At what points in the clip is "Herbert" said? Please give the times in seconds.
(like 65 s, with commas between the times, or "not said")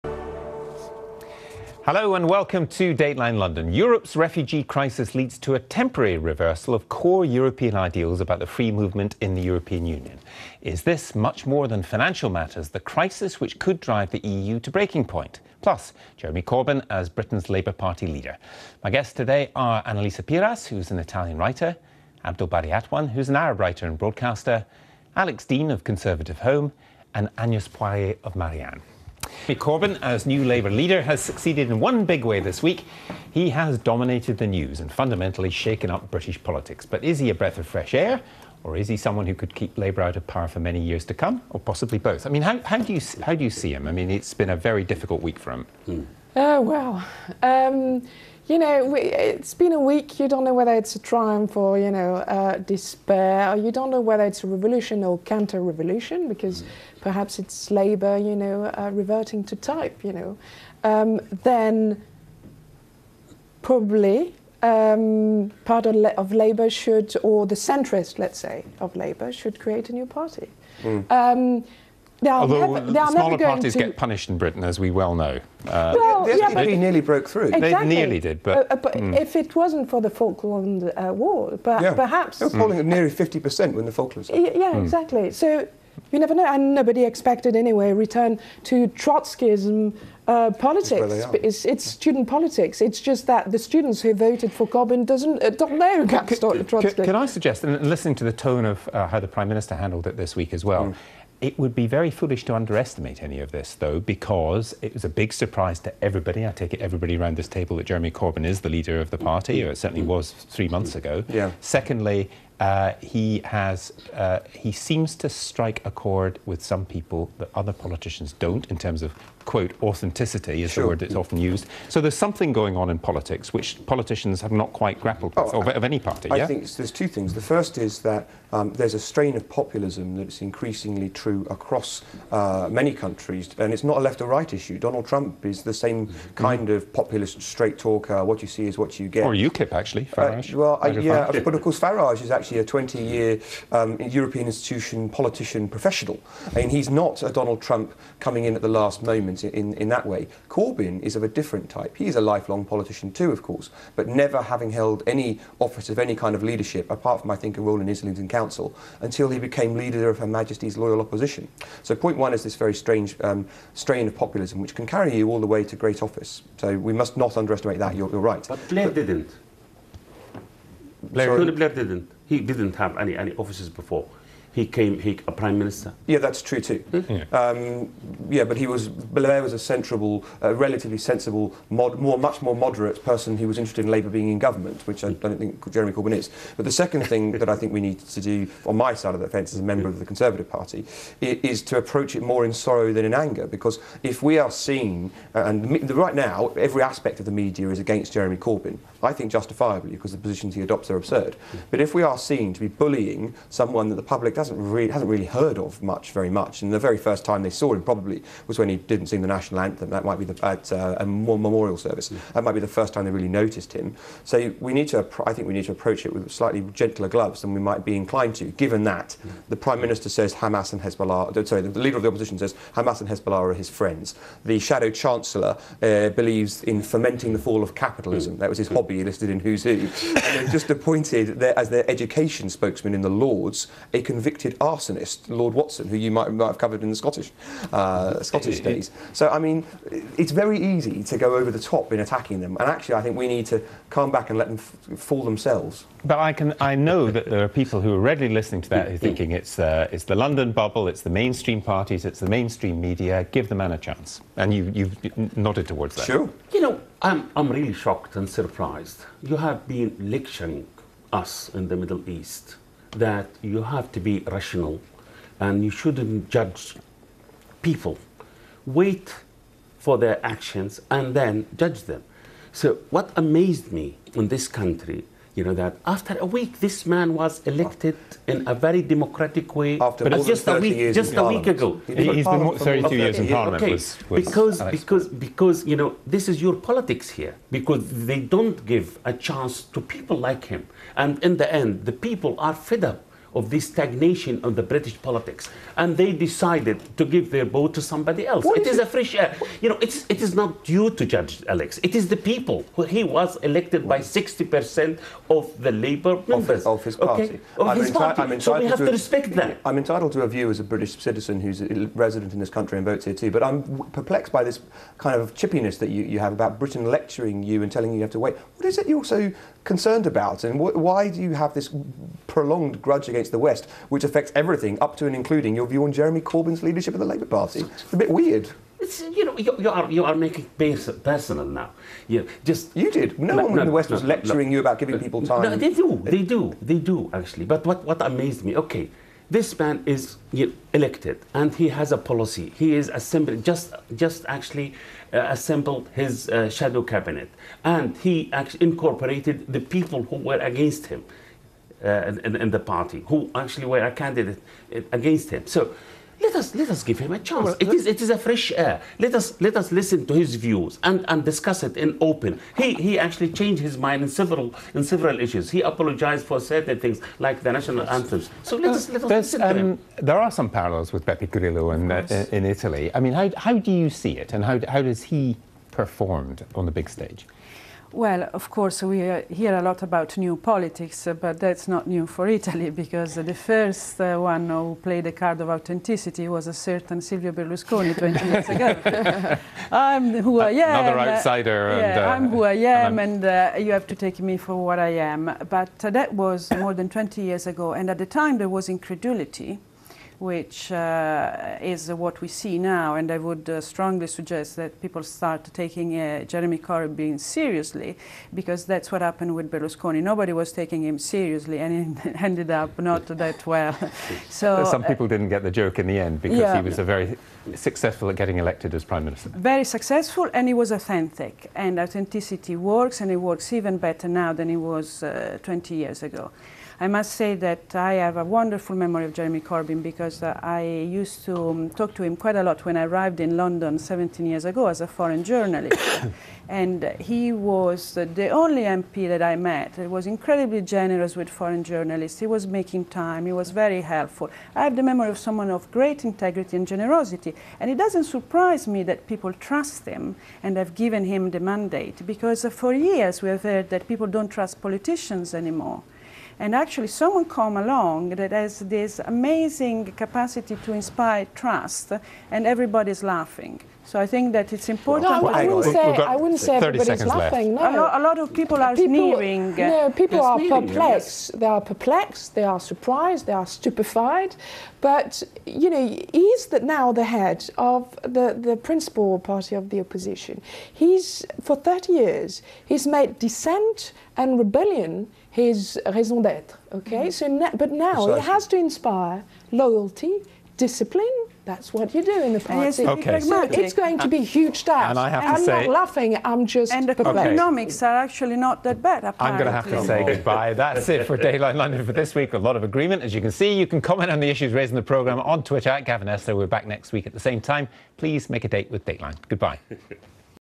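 not said.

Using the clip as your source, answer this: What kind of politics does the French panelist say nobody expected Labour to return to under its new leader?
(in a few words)
Trotskyism.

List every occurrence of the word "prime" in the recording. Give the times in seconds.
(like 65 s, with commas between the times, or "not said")
99 s, 175 s, 219 s, 418 s.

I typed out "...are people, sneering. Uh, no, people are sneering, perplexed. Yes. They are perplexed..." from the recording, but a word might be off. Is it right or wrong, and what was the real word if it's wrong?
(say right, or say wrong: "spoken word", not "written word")
right.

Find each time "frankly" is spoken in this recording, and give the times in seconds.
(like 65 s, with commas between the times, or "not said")
not said.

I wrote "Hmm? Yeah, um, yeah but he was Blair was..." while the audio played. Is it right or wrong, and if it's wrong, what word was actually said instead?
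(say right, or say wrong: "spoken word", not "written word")
right.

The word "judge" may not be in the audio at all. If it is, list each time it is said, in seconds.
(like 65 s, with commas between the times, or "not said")
266 s, 271 s, 301 s.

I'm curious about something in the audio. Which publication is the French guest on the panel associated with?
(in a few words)
Marianne.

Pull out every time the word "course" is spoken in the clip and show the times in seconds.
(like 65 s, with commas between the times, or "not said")
141 s, 153 s, 378 s.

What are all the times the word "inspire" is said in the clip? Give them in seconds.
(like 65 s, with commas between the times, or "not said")
460 s, 488 s.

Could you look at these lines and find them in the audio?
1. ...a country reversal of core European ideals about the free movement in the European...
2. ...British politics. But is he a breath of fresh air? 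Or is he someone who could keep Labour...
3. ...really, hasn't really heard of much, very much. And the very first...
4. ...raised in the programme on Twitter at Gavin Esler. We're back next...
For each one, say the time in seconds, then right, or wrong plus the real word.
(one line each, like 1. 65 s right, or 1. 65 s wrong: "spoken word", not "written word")
1. 5 s wrong: "temporary", not "country"
2. 36 s right
3. 204 s right
4. 504 s right.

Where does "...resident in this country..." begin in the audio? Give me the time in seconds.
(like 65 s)
311 s.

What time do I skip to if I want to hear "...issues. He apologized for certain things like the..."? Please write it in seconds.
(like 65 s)
365 s.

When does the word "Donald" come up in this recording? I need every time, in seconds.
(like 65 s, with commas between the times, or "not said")
134 s, 147 s.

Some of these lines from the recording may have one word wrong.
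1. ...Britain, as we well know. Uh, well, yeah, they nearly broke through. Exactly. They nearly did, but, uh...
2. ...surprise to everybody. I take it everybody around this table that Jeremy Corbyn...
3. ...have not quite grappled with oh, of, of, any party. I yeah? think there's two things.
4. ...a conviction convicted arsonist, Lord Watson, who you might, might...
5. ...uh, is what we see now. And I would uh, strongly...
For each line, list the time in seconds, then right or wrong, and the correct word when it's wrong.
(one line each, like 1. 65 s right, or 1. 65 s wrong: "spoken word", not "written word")
1. 74 s right
2. 105 s right
3. 124 s right
4. 233 s right
5. 400 s right.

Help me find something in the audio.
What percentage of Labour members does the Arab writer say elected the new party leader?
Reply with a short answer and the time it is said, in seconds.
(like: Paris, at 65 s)
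60%, at 303 s.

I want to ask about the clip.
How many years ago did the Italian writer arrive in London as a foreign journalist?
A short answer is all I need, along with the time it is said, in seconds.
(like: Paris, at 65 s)
17, at 433 s.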